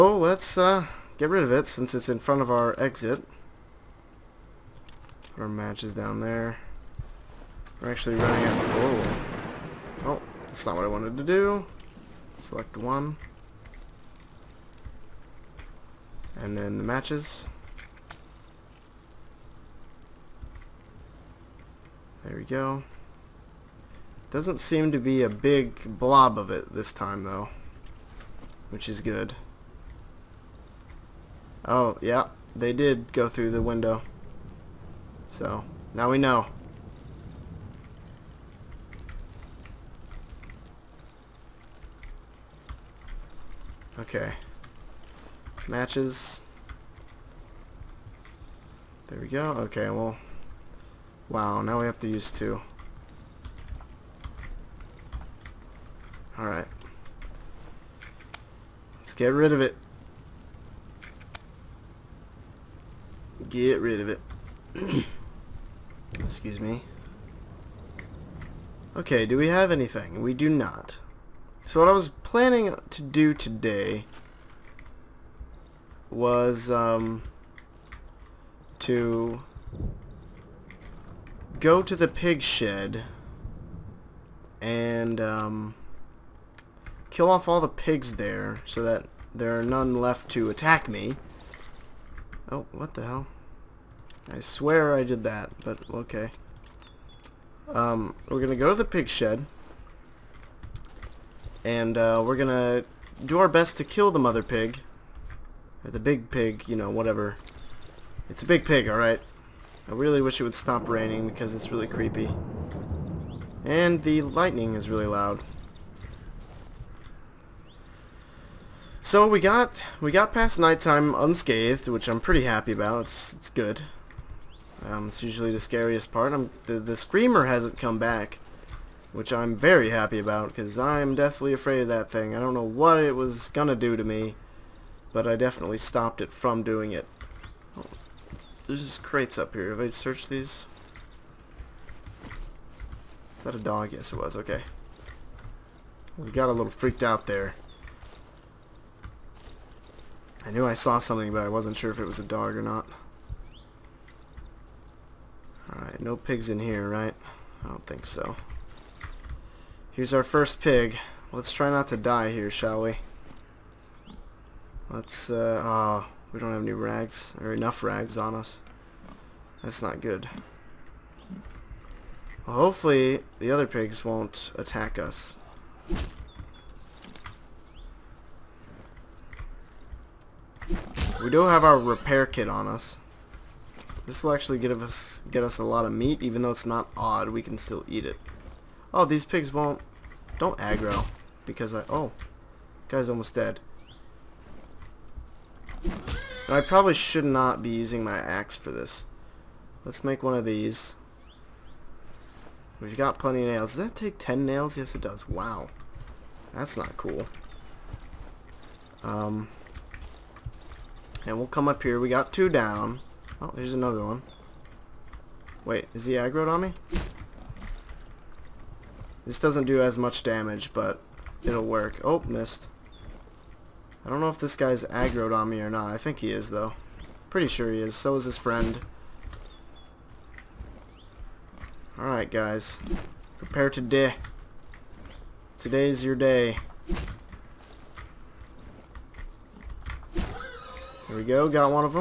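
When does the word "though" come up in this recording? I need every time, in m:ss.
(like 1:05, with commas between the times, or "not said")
0:27, 3:06, 3:46.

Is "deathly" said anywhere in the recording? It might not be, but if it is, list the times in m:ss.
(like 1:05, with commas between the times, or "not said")
2:11.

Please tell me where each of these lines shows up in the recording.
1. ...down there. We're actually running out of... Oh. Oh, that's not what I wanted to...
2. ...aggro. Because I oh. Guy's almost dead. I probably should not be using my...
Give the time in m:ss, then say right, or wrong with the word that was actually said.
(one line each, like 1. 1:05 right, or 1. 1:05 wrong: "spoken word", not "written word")
1. 0:05 right
2. 3:10 right.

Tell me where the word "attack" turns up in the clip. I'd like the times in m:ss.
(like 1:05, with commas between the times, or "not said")
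1:30, 2:54.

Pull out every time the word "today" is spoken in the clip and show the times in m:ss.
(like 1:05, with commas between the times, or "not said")
1:13, 3:55.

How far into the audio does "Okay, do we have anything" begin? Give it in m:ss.
1:08.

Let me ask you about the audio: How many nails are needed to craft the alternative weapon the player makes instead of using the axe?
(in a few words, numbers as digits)
10.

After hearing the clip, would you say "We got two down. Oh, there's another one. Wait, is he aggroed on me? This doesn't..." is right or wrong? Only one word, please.
right.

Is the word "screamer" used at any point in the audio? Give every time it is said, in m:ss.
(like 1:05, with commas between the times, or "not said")
2:06.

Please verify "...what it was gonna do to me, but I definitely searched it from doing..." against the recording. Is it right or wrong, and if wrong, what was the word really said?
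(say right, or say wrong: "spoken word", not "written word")
wrong: "stopped", not "searched".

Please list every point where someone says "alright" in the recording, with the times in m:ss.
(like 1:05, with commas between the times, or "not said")
0:56, 1:48, 2:35, 3:51.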